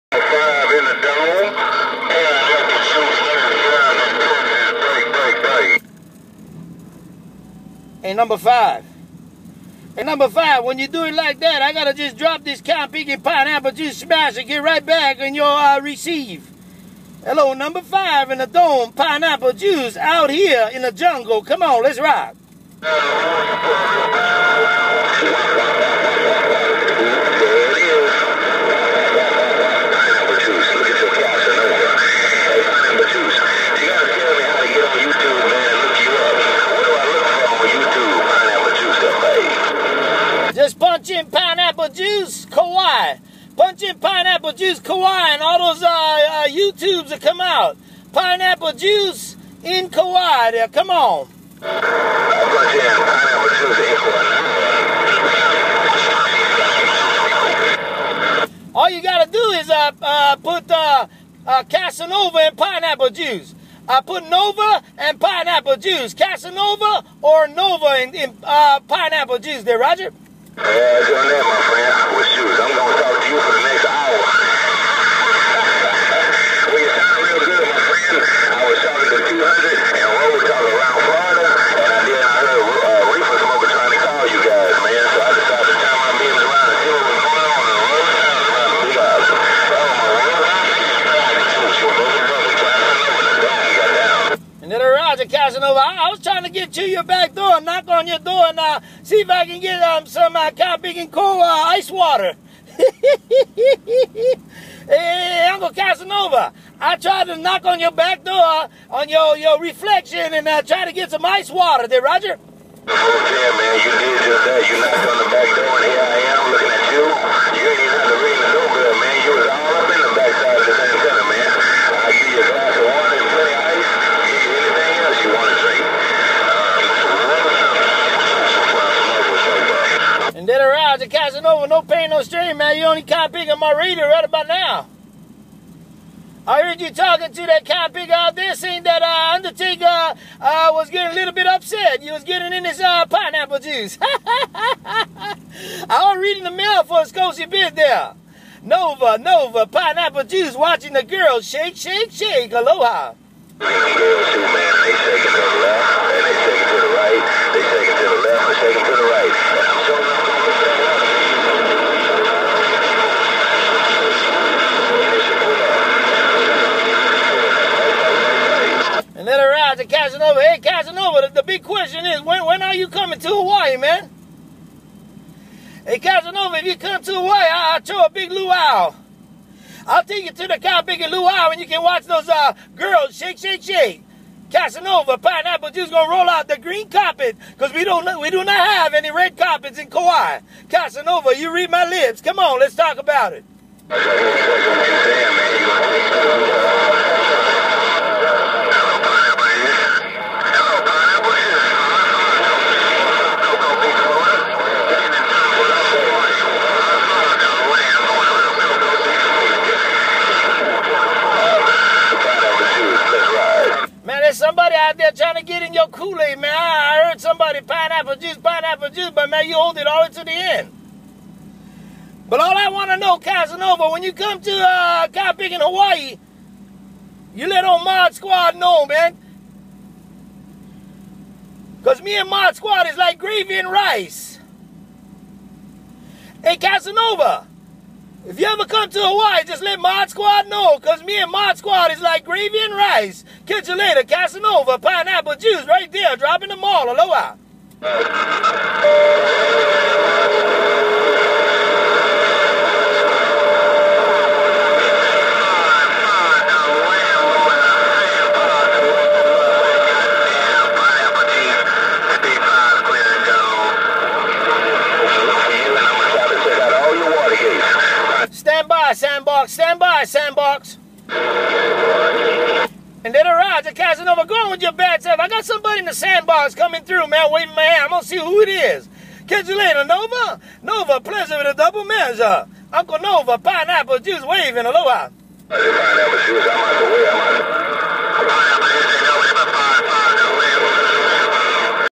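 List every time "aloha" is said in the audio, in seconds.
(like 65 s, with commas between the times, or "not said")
152 s, 246 s, 284 s.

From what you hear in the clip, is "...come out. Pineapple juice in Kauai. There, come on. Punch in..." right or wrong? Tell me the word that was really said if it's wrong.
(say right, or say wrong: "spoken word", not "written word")
right.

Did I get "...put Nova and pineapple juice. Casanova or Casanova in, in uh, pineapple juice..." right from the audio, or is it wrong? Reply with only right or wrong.
wrong.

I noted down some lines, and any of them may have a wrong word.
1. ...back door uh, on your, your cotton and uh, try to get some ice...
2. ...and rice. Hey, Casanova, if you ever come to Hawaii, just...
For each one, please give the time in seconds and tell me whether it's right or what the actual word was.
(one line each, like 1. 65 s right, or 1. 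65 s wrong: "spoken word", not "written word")
1. 107 s wrong: "reflection", not "cotton"
2. 233 s right.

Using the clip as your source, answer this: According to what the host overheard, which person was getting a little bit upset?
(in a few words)
Undertaker.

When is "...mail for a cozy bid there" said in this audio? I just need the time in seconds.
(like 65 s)
146 s.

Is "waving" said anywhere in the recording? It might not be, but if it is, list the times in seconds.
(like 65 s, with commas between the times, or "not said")
277 s, 284 s.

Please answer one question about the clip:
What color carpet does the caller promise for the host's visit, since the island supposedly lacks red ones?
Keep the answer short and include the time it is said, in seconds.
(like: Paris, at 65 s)
Green, at 186 s.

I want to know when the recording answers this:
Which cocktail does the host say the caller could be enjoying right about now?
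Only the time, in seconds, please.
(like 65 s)
133 s.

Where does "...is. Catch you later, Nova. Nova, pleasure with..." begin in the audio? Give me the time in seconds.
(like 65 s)
278 s.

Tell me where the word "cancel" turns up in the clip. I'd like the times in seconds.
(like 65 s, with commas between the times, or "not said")
not said.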